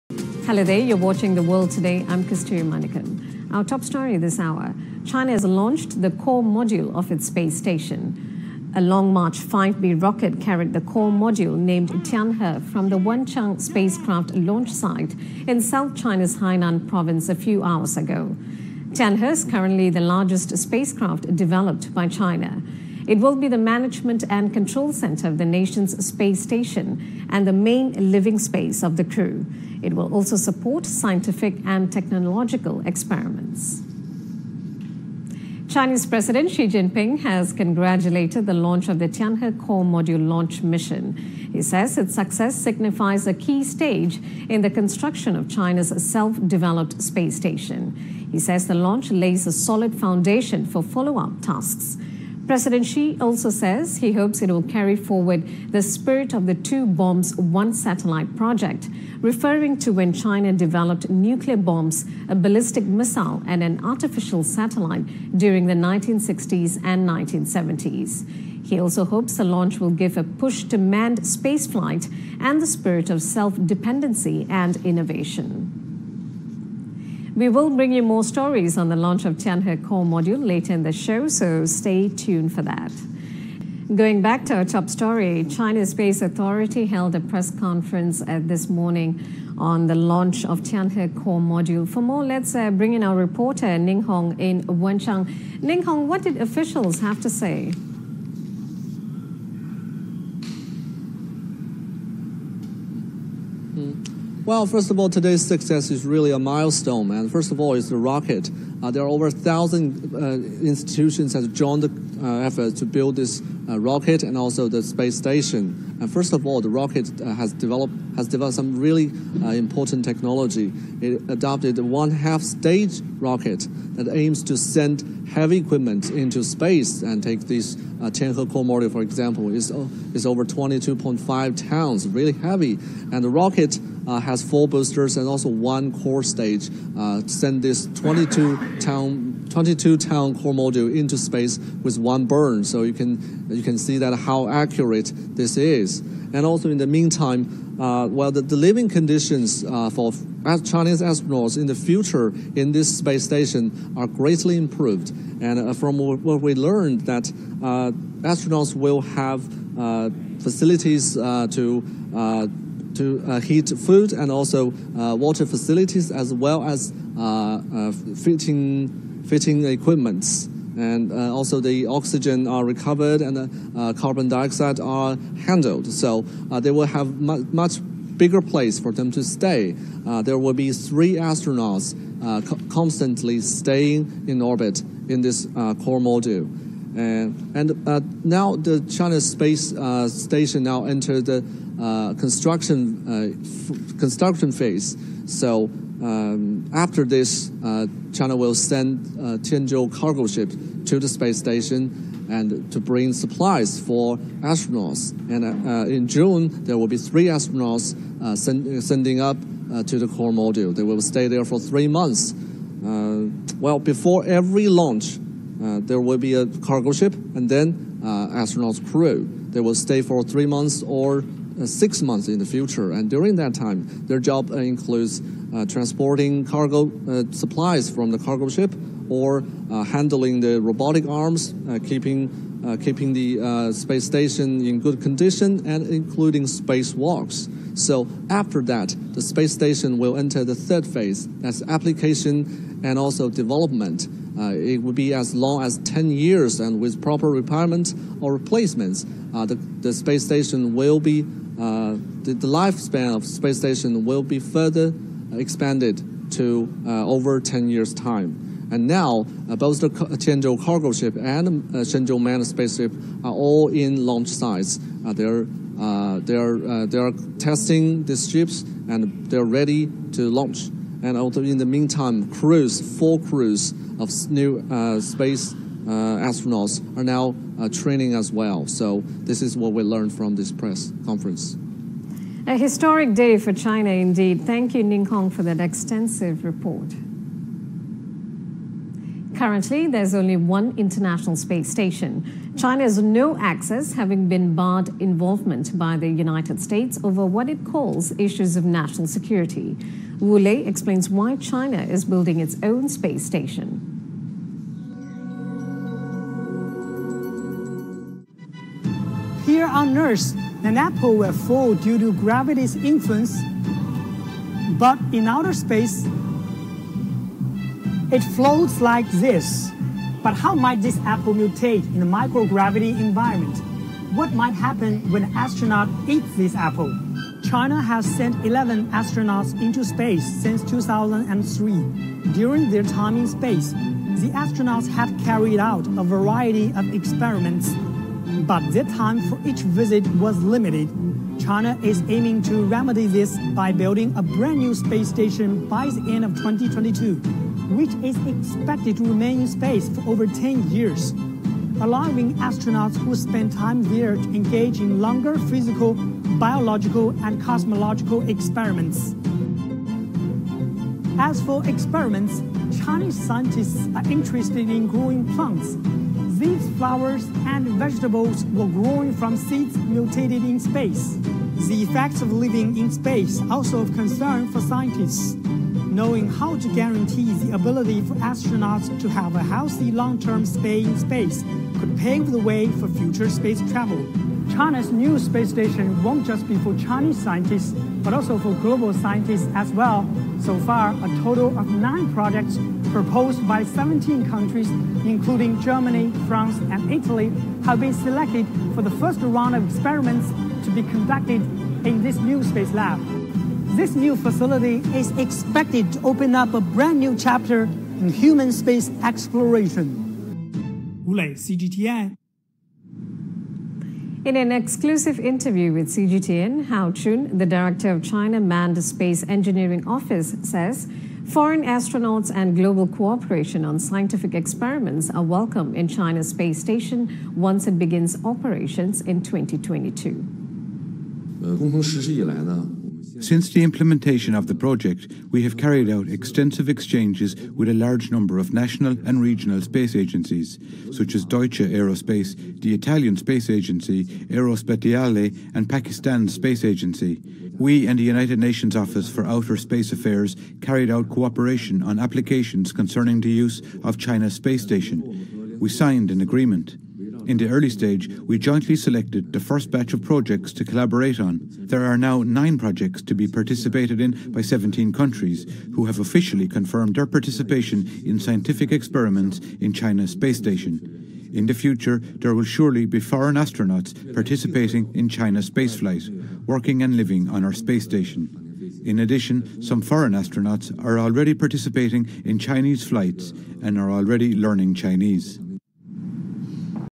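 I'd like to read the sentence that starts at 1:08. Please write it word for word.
He also hopes the launch will give a push to manned spaceflight and the spirit of self dependency and innovation.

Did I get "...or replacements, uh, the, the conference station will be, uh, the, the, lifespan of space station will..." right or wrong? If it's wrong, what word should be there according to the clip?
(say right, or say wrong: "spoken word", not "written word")
wrong: "space", not "conference".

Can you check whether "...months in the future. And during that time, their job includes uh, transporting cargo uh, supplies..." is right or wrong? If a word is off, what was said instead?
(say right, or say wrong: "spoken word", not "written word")
right.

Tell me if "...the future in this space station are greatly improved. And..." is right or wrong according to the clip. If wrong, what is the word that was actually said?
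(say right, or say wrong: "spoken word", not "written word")
right.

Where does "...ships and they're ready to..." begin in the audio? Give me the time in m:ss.
4:28.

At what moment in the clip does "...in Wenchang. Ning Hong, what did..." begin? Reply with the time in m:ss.
1:34.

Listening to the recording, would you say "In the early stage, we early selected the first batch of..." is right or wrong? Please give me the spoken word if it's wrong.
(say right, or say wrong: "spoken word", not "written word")
wrong: "jointly", not "early".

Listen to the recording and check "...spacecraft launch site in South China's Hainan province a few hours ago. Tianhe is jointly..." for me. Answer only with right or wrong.
wrong.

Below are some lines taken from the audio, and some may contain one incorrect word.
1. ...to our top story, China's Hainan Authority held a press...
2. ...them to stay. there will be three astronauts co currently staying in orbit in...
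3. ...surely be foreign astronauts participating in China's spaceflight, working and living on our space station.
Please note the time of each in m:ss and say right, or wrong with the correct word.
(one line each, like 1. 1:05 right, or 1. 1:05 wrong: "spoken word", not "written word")
1. 1:24 wrong: "Space", not "Hainan"
2. 2:58 wrong: "constantly", not "currently"
3. 7:52 right.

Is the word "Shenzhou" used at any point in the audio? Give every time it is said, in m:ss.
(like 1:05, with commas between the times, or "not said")
4:21.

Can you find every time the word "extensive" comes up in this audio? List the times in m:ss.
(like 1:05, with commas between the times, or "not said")
4:45, 7:16.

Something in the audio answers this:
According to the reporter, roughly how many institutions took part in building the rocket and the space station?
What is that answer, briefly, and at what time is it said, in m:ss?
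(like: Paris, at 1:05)
over 1000, at 1:49.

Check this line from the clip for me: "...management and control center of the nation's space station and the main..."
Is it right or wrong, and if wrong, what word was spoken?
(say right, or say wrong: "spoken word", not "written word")
right.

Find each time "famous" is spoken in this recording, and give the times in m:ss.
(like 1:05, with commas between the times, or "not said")
not said.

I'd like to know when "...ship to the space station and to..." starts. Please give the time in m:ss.
3:20.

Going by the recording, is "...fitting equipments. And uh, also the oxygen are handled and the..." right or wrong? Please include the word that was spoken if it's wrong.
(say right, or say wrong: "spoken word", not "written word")
wrong: "recovered", not "handled".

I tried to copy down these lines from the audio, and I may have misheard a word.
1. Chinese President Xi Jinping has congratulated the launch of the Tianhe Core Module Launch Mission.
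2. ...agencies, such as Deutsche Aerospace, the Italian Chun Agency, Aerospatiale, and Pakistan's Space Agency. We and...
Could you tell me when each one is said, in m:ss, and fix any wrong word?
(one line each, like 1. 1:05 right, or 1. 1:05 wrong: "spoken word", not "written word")
1. 0:35 right
2. 7:19 wrong: "Space", not "Chun".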